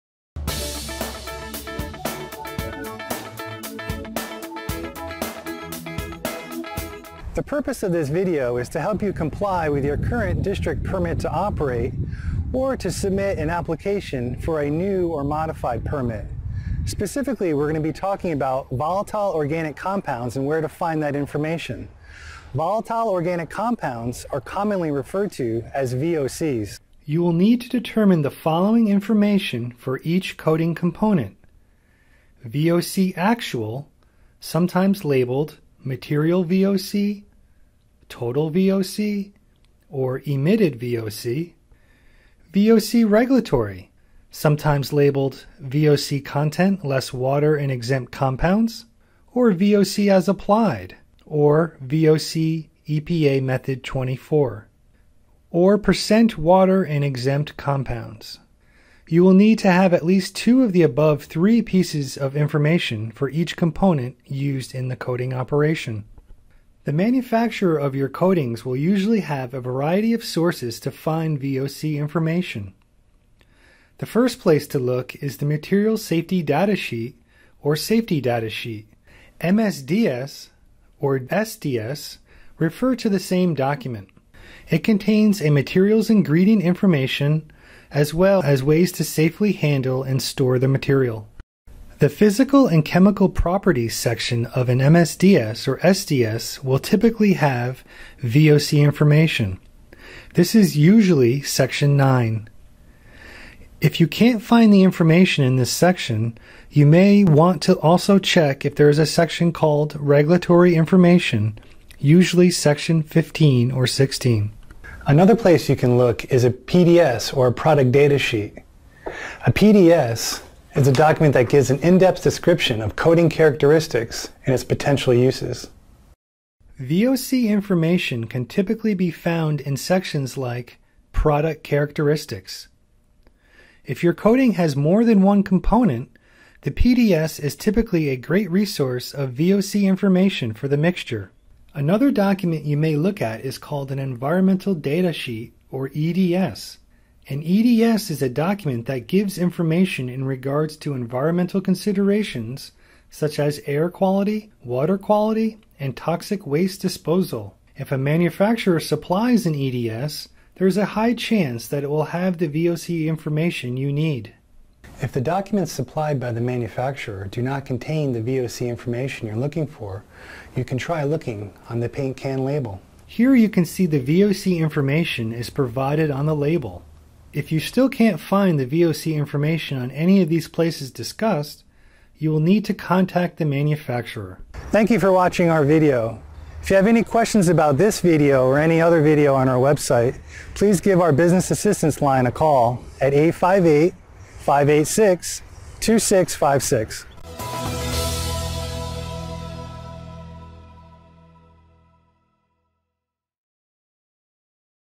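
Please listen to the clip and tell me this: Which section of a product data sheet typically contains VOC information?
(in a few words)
Product Characteristics.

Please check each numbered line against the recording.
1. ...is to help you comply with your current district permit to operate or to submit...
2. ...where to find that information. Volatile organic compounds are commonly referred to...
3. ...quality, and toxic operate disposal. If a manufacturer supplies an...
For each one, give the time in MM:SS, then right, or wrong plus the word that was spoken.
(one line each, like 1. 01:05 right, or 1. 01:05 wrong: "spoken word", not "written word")
1. 00:08 right
2. 00:20 right
3. 02:34 wrong: "waste", not "operate".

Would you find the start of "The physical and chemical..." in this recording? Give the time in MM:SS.
01:32.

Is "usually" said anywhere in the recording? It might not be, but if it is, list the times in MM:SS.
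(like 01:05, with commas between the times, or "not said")
01:08, 01:40, 01:51.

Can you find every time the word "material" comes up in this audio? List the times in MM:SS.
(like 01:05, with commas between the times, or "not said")
00:35, 01:15, 01:25, 01:30.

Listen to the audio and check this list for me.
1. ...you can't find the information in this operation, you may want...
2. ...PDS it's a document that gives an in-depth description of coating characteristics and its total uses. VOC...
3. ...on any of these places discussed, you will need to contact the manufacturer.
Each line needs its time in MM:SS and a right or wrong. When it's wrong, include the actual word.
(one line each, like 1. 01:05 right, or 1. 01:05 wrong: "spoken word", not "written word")
1. 01:43 wrong: "section", not "operation"
2. 01:59 wrong: "potential", not "total"
3. 02:59 right.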